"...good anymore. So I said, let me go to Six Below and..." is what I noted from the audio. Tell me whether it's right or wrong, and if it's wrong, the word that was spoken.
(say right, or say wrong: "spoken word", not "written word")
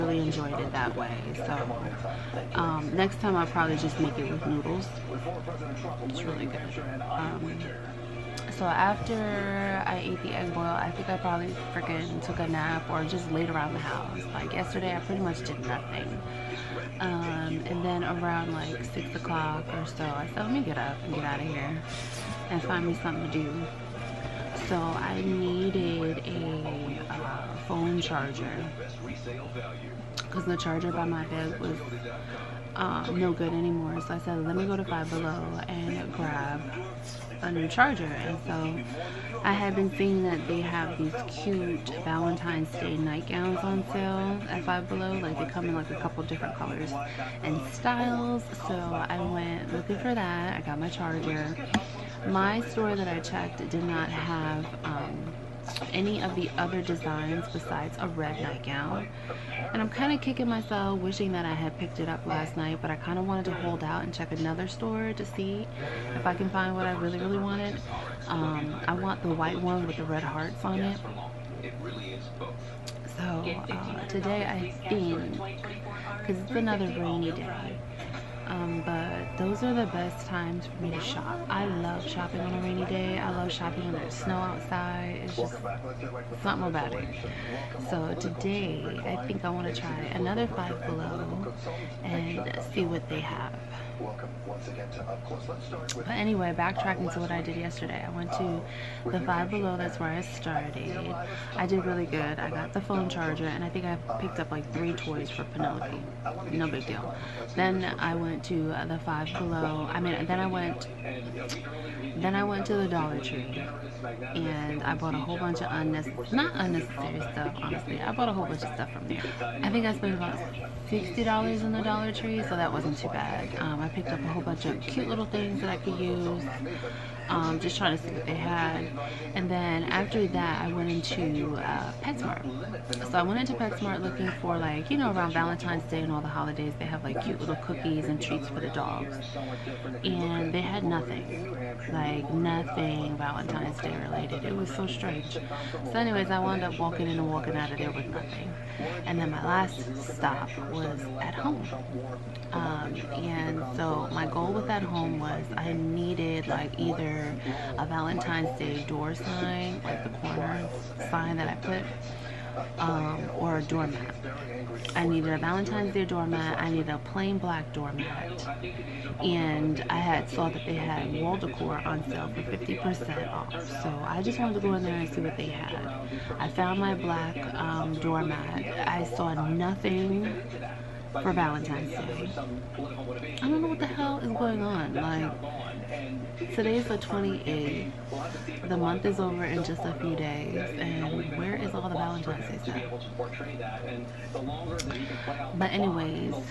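wrong: "Five", not "Six".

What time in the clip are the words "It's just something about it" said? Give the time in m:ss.
1:25.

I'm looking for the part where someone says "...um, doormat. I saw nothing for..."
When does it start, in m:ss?
2:57.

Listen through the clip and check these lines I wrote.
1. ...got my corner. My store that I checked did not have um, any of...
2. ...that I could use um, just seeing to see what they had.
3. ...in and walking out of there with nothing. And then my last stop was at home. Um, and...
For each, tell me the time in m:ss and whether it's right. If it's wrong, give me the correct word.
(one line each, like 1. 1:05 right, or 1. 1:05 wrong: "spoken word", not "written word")
1. 0:50 wrong: "charger", not "corner"
2. 2:05 wrong: "trying", not "seeing"
3. 2:27 right.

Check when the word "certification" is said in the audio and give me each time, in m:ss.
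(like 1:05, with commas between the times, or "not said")
not said.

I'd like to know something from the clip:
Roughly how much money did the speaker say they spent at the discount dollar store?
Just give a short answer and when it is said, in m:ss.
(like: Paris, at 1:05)
$60, at 2:00.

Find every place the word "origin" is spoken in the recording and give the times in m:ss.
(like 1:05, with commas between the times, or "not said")
not said.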